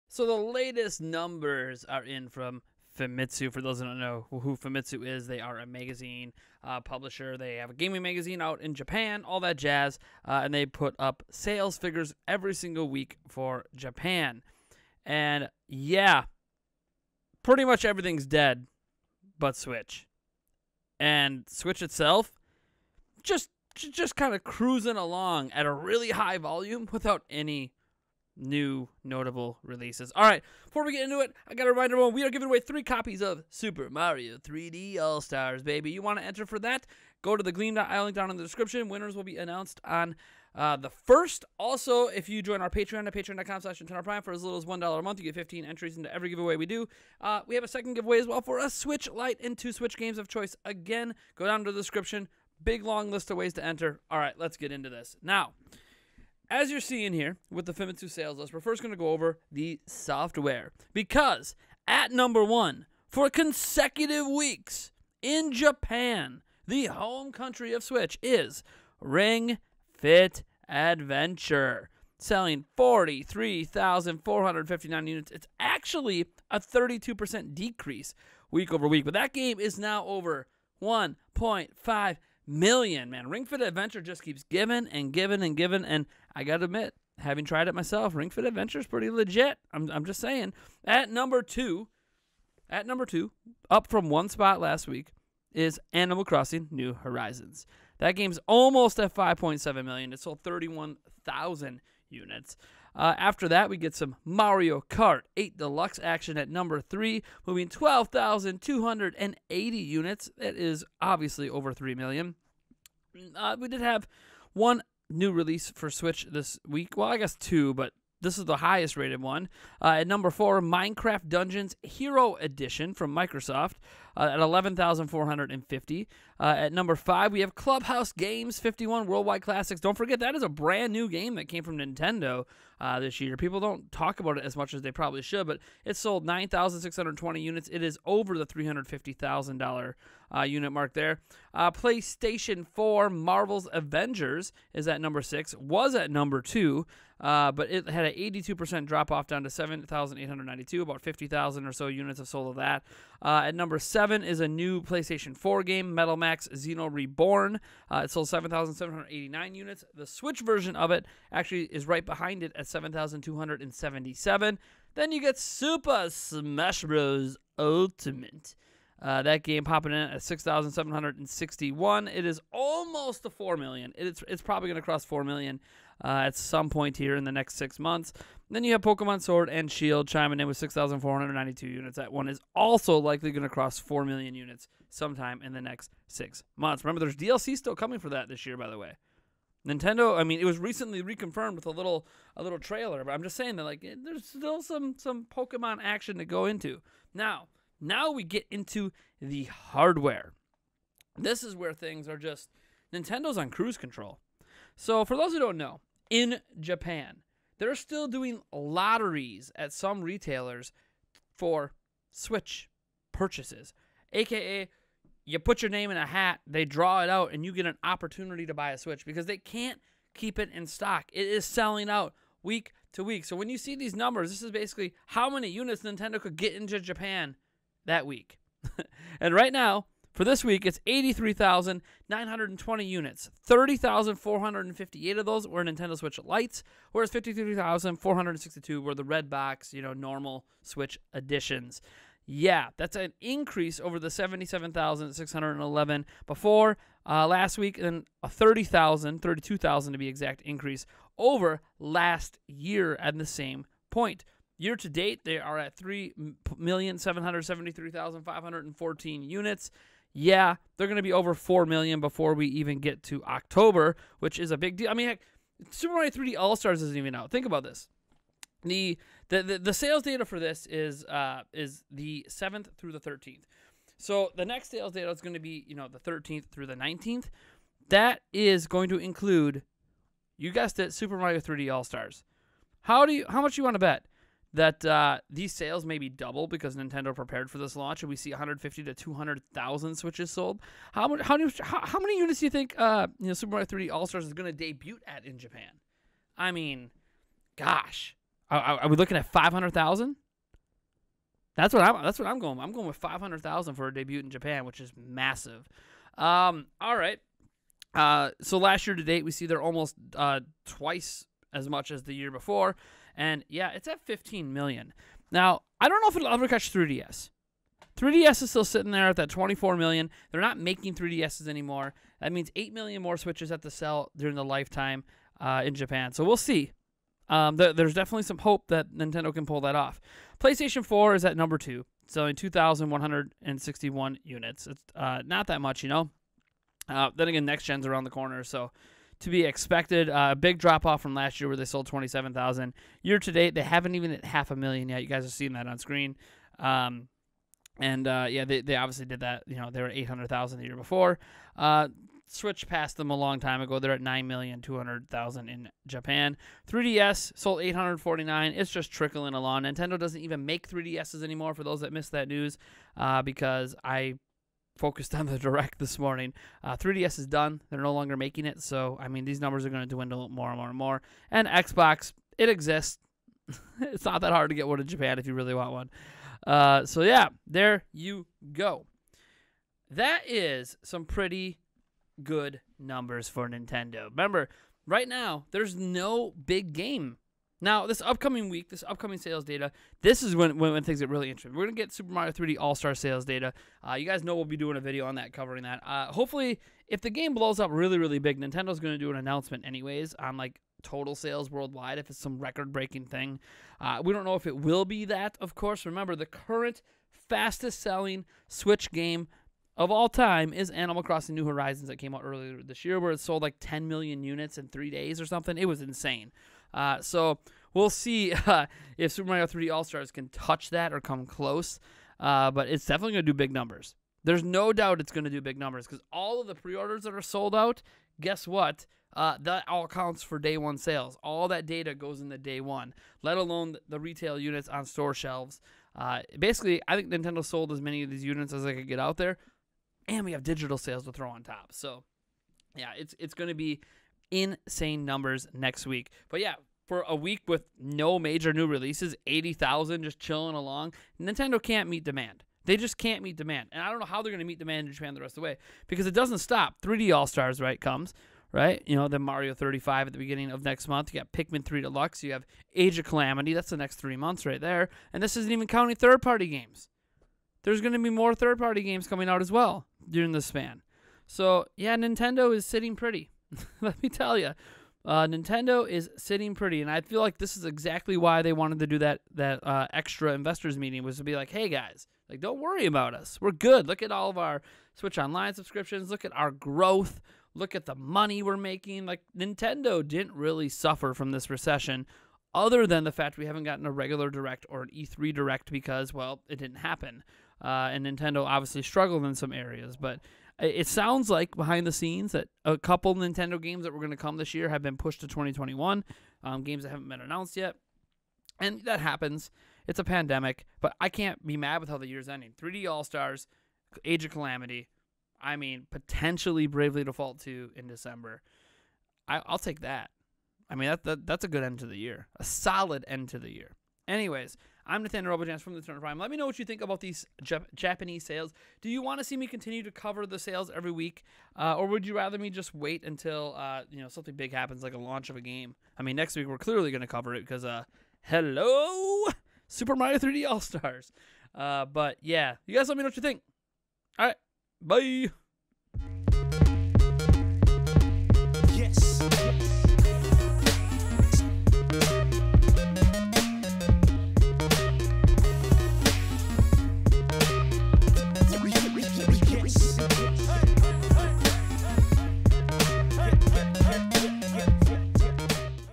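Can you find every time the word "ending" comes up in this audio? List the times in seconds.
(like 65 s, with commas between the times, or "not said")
512 s.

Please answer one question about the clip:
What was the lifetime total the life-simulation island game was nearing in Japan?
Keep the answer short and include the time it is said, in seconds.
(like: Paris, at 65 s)
5.7 million, at 99 s.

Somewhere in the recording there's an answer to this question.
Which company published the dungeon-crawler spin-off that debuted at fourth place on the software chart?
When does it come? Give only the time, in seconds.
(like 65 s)
123 s.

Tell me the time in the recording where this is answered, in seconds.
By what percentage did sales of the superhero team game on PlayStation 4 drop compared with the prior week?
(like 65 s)
148 s.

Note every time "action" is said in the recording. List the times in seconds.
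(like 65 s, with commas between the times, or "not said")
106 s, 195 s.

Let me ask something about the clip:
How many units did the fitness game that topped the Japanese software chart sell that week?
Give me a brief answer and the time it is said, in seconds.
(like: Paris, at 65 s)
43,459, at 72 s.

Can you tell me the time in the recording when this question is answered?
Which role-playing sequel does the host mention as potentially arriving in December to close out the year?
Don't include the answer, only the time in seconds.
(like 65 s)
516 s.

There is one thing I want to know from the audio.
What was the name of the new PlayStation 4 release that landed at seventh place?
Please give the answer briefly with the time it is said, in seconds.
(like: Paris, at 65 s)
Metal Max Xeno Reborn, at 155 s.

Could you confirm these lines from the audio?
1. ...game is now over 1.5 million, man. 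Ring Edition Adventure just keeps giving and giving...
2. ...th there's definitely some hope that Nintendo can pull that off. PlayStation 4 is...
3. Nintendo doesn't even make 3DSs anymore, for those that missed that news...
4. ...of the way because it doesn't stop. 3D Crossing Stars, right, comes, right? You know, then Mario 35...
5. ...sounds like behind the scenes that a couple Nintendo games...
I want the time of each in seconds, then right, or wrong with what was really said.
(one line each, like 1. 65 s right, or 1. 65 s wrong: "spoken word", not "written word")
1. 79 s wrong: "Fit", not "Edition"
2. 327 s right
3. 359 s right
4. 455 s wrong: "All", not "Crossing"
5. 500 s right.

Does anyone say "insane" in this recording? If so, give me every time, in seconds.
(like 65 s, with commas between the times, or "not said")
415 s, 444 s.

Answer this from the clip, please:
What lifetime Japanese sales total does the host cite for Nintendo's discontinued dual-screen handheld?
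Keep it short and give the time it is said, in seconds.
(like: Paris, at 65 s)
24 million, at 319 s.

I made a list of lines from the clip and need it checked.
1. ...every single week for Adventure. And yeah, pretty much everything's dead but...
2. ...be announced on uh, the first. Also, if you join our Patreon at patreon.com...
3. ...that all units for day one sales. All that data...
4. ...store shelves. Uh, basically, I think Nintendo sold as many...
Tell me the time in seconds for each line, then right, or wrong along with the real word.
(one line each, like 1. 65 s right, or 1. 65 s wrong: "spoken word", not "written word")
1. 12 s wrong: "Japan", not "Adventure"
2. 39 s right
3. 429 s wrong: "counts", not "units"
4. 434 s right.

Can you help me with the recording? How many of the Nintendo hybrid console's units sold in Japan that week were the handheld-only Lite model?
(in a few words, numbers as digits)
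30,458.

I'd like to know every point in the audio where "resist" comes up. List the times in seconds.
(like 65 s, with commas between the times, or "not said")
not said.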